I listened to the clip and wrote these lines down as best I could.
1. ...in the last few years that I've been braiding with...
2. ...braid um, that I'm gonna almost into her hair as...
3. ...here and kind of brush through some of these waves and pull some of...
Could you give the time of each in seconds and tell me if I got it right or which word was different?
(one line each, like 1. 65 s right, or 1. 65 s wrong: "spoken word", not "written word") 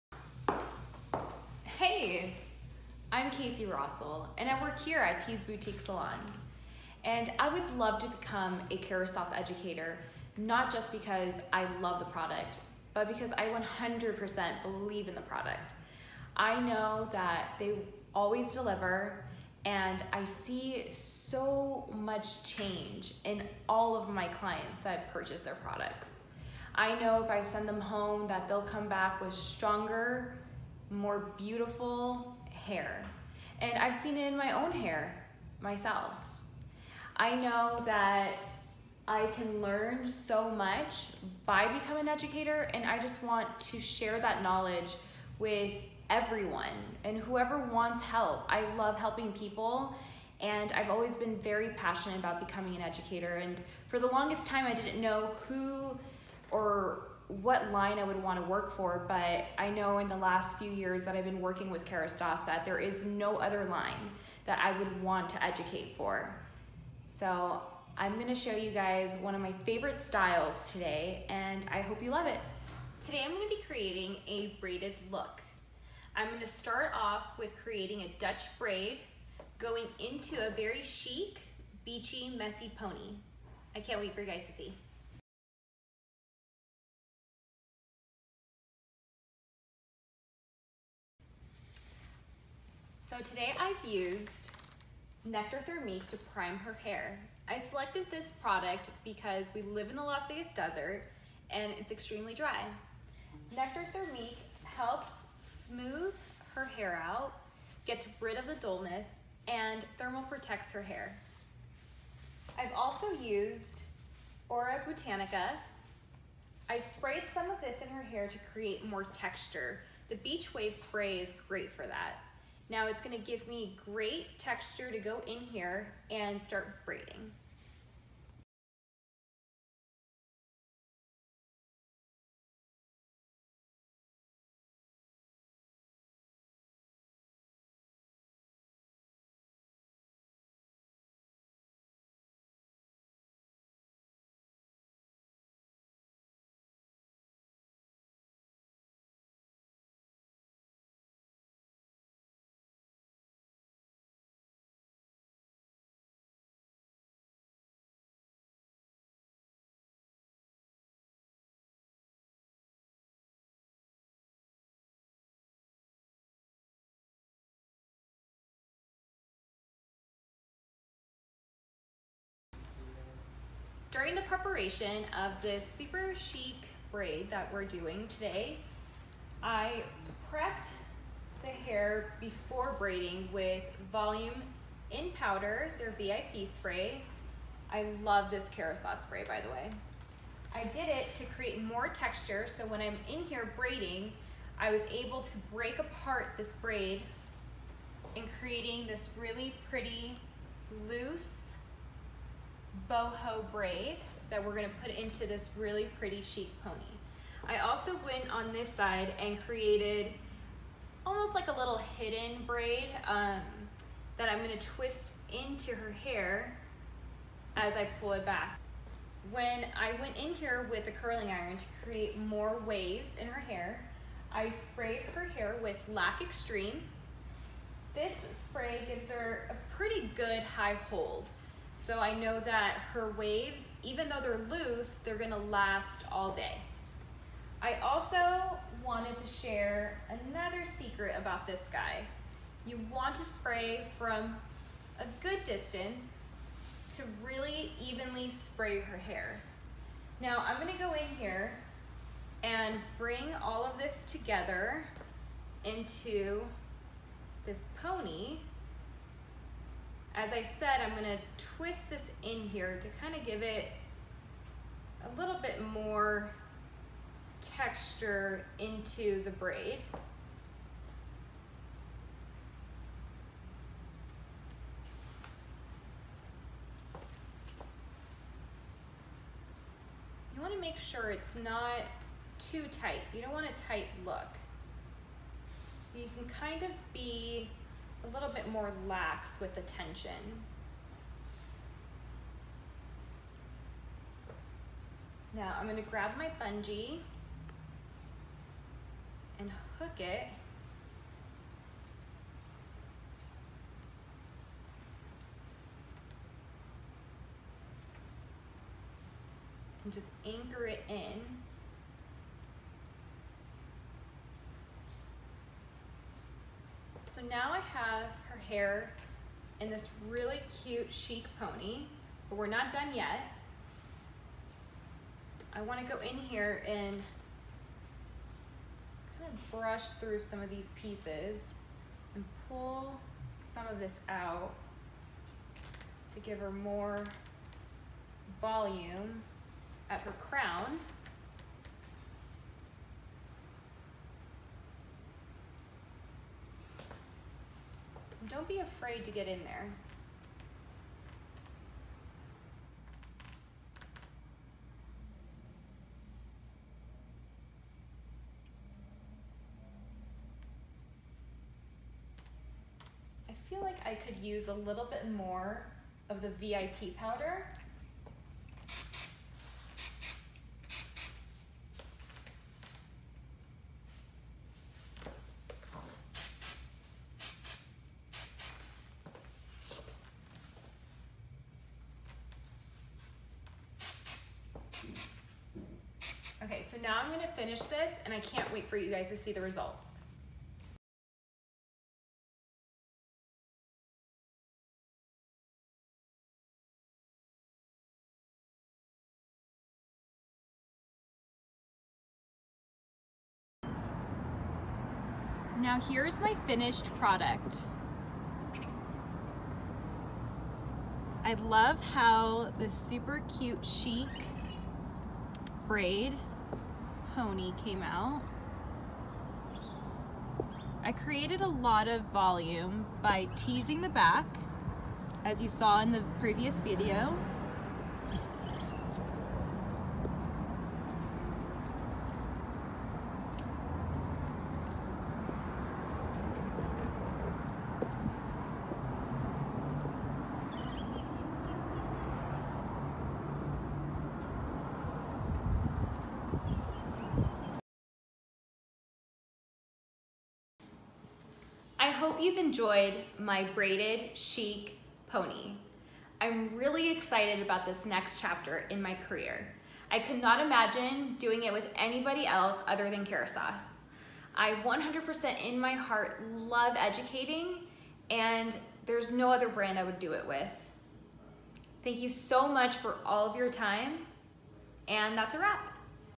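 1. 59 s wrong: "working", not "braiding"
2. 212 s wrong: "twist", not "almost"
3. 326 s wrong: "pieces", not "waves".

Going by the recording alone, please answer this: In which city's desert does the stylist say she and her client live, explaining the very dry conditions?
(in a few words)
Las Vegas.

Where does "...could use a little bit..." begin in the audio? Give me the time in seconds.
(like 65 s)
363 s.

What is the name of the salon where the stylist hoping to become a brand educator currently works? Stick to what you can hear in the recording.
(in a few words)
Tees Boutique Salon.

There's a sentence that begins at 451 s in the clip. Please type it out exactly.
I hope you've enjoyed my braided chic pony.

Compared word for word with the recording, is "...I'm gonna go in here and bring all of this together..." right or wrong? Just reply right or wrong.
right.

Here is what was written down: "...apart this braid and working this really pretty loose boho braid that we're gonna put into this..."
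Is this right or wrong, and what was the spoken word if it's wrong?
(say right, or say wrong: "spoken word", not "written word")
wrong: "creating", not "working".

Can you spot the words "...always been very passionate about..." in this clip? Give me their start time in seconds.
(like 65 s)
50 s.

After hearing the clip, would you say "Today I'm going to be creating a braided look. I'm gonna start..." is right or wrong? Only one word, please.
right.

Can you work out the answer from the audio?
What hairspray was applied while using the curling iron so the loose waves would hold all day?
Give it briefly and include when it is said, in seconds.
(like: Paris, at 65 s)
Lac Extreme, at 225 s.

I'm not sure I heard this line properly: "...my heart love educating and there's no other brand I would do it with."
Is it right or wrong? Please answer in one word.
right.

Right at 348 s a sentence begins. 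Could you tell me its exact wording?
don't be afraid to get in there.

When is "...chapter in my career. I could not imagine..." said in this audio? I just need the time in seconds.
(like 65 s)
458 s.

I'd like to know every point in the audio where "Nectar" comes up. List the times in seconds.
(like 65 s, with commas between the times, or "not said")
95 s, 103 s.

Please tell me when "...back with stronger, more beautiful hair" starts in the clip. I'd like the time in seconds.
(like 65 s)
28 s.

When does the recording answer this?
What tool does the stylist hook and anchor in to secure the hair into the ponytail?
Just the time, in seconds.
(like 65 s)
296 s.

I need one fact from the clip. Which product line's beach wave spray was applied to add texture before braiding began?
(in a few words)
Aura Botanica.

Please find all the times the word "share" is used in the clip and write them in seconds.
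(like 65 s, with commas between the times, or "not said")
43 s, 239 s.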